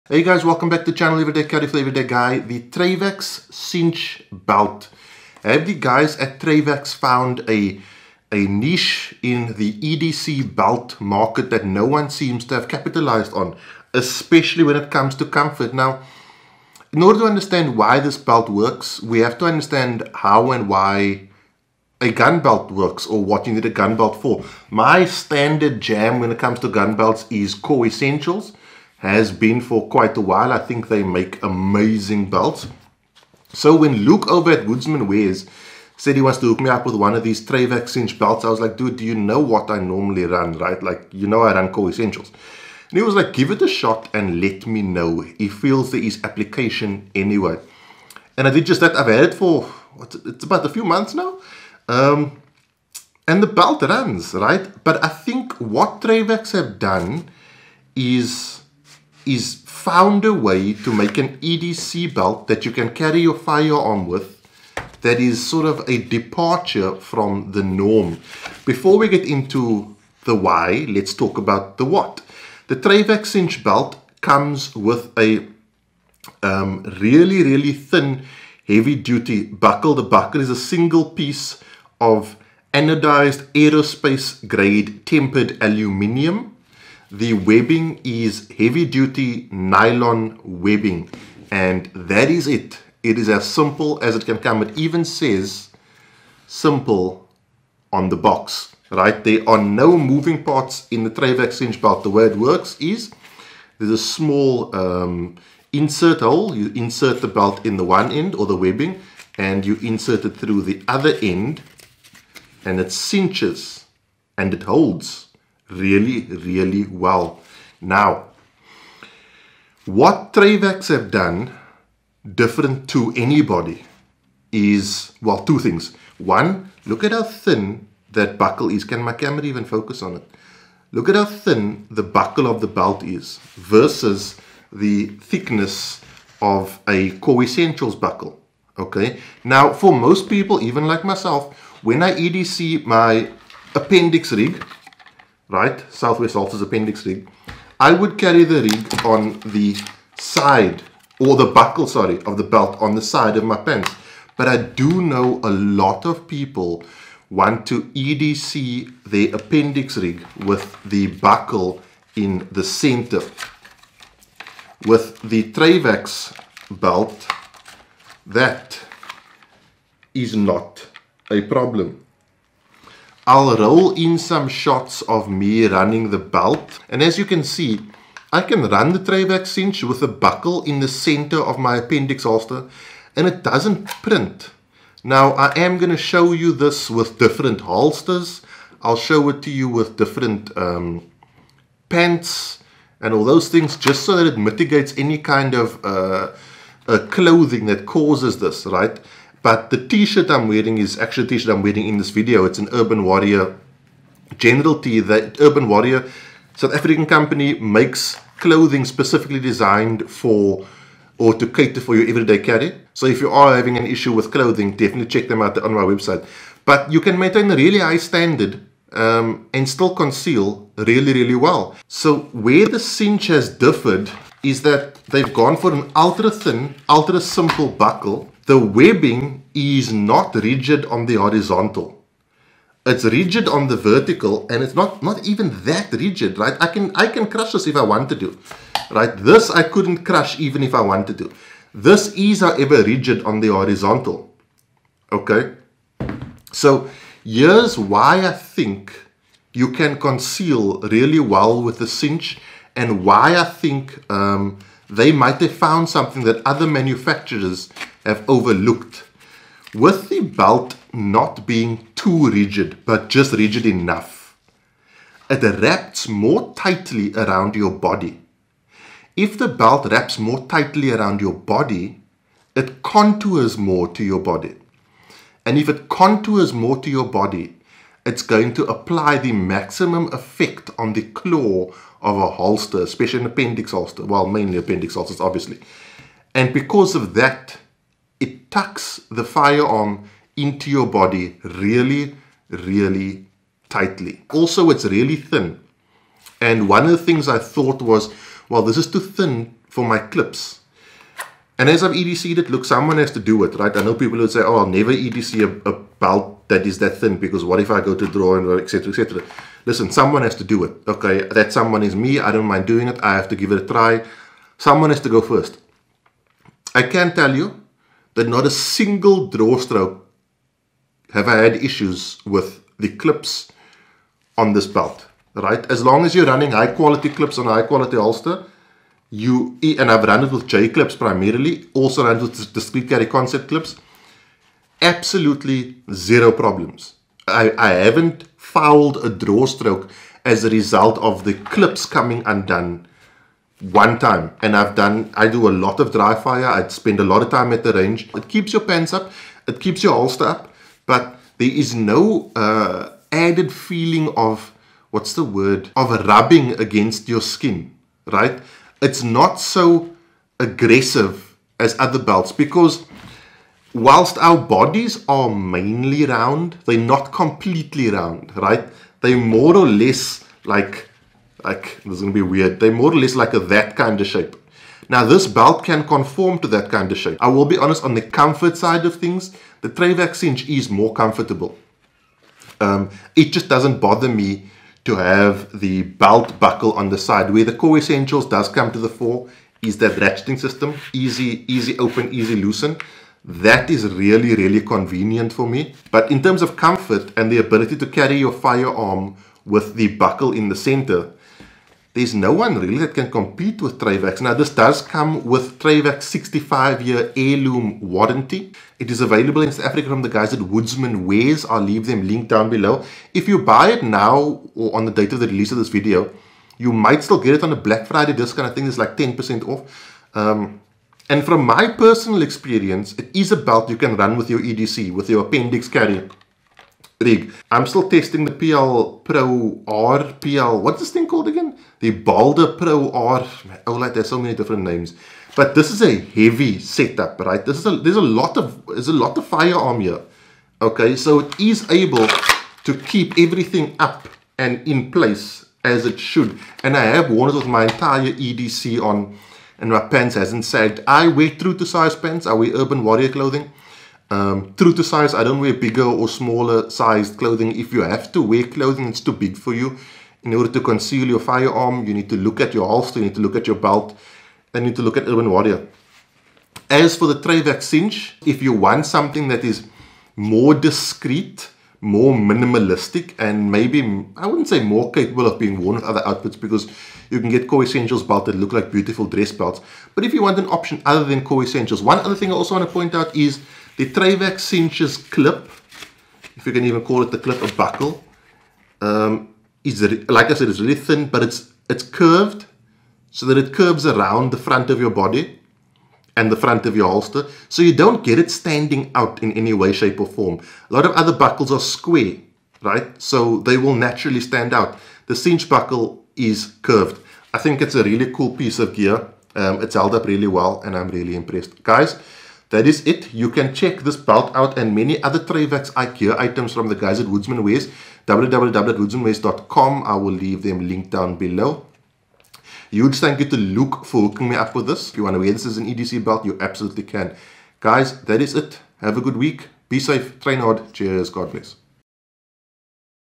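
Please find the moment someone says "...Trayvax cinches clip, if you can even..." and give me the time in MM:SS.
08:03.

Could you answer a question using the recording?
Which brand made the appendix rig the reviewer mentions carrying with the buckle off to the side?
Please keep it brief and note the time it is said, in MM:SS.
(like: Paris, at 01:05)
Southwest, at 02:25.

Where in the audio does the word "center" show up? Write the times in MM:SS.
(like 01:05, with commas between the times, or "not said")
02:42, 03:00, 06:40.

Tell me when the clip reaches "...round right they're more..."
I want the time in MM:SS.
06:07.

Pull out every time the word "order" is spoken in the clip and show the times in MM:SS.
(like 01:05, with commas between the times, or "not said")
00:17, 07:40.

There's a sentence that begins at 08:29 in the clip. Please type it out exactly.
Um, it's held up really well, and I'm really impressed.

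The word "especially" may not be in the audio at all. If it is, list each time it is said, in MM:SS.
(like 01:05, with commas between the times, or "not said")
00:13, 04:42.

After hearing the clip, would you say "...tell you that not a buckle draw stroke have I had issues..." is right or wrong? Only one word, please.
wrong.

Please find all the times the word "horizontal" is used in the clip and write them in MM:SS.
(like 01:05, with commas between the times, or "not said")
03:51, 04:03.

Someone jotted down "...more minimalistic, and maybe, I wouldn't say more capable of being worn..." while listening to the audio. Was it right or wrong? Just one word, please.
right.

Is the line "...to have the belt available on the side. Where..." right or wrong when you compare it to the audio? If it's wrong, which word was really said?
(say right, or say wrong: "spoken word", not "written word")
wrong: "buckle", not "available".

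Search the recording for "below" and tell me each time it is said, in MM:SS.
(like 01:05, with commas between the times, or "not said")
06:52, 08:41.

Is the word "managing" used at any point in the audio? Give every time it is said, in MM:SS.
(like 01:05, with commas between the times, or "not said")
not said.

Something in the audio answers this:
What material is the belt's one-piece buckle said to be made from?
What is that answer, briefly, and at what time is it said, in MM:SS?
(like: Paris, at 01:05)
Aluminium, at 01:25.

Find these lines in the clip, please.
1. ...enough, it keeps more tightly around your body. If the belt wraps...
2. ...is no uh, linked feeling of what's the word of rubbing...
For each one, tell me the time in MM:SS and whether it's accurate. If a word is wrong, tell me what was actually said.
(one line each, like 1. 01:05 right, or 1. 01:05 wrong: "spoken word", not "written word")
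1. 04:23 wrong: "wraps", not "keeps"
2. 05:51 wrong: "added", not "linked".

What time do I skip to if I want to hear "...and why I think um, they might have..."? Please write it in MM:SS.
04:12.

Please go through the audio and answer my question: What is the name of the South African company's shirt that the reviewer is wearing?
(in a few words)
General T.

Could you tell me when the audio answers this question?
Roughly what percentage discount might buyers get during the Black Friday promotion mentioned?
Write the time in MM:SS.
06:58.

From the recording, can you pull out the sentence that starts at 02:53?
I'll roll in some shots of me running the belt.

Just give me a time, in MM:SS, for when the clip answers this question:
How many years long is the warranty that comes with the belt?
06:46.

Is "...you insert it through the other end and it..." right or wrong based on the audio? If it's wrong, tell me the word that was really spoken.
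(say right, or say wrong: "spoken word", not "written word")
right.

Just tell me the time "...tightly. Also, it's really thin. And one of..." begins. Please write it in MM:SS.
04:53.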